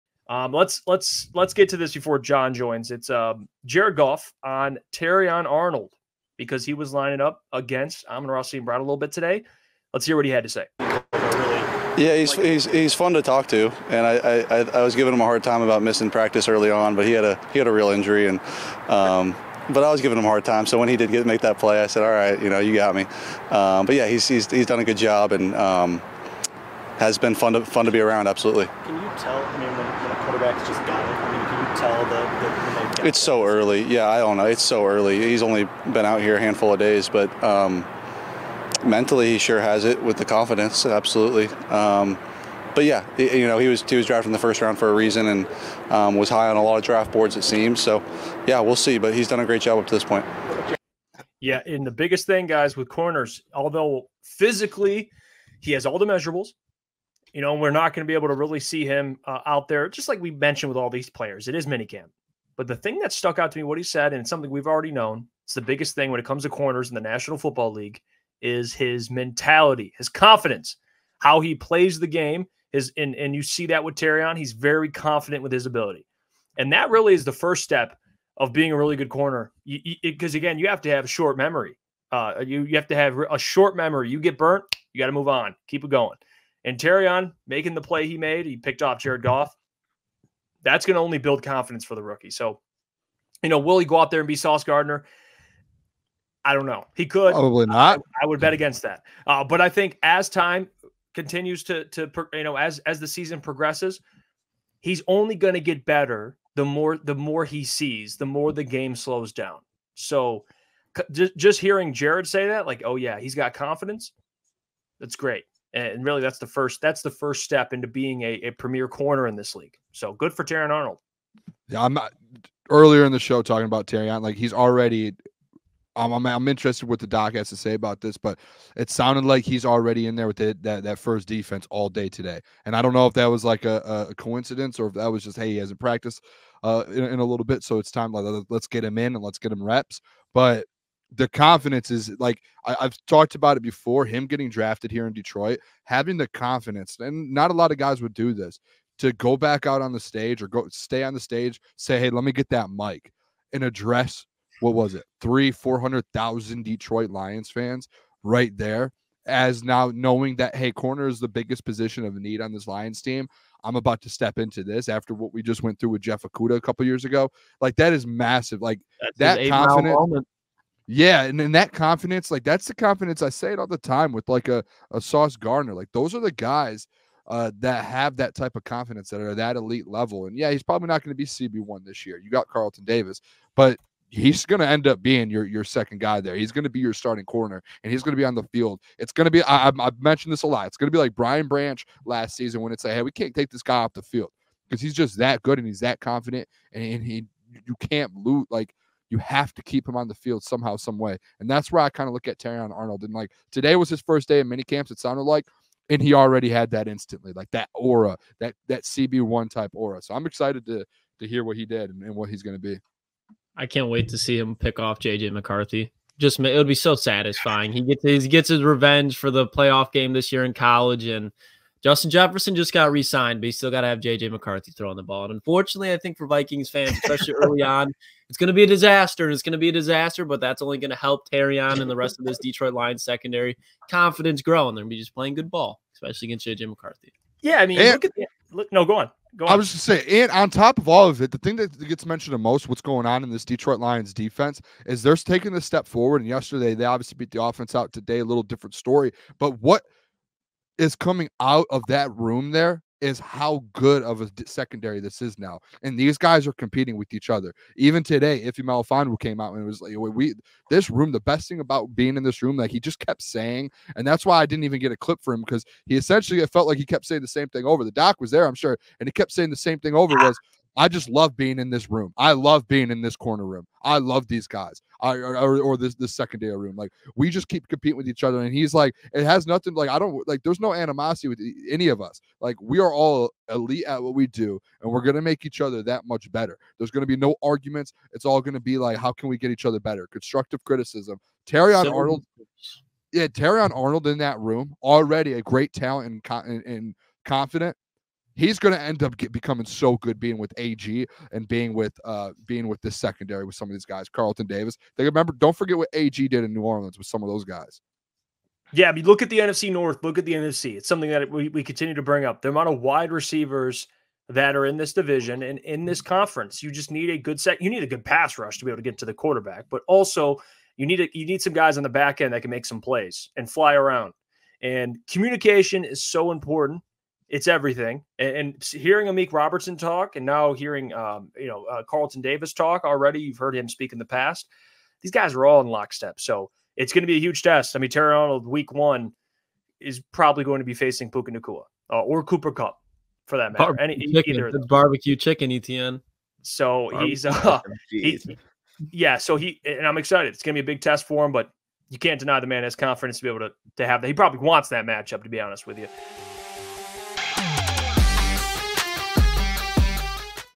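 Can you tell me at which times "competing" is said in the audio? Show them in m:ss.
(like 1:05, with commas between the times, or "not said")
4:16, 4:37.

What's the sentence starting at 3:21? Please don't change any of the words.
And that's where I kind of look at Terrion Arnold.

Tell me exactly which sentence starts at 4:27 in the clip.
The doc was there, I'm sure, and he kept saying the same thing over ah.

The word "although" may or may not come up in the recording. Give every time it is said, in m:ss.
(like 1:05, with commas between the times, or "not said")
0:53.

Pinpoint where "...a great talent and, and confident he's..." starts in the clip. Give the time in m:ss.
4:55.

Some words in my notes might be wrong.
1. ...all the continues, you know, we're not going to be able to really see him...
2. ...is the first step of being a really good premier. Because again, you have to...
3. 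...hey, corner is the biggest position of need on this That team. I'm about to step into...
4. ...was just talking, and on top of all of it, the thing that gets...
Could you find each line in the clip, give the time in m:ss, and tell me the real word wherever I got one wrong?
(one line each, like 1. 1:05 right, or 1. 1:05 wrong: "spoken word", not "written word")
1. 0:55 wrong: "measurables", not "continues"
2. 1:17 wrong: "corner", not "premier"
3. 2:40 wrong: "Lions", not "That"
4. 3:59 wrong: "saying", not "talking".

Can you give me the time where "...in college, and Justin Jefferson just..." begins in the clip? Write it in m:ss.
3:40.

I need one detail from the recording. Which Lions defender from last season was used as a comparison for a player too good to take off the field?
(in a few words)
Brian Branch.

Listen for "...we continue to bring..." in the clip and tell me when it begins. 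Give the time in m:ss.
5:11.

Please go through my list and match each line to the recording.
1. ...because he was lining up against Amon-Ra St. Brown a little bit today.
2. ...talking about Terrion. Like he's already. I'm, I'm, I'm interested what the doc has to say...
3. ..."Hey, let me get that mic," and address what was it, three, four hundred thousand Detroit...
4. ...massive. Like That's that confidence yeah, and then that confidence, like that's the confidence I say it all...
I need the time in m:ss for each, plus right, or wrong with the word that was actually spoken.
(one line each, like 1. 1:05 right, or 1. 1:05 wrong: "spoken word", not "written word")
1. 0:06 right
2. 2:03 right
3. 2:31 right
4. 2:48 right.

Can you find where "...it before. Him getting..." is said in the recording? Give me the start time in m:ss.
2:23.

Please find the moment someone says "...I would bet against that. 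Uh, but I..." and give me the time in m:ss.
1:38.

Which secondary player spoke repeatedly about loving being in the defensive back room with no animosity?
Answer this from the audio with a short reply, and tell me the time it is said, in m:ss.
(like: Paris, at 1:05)
Ifeatu Melifonwu, at 4:18.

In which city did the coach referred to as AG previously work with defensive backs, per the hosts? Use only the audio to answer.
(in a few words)
New Orleans.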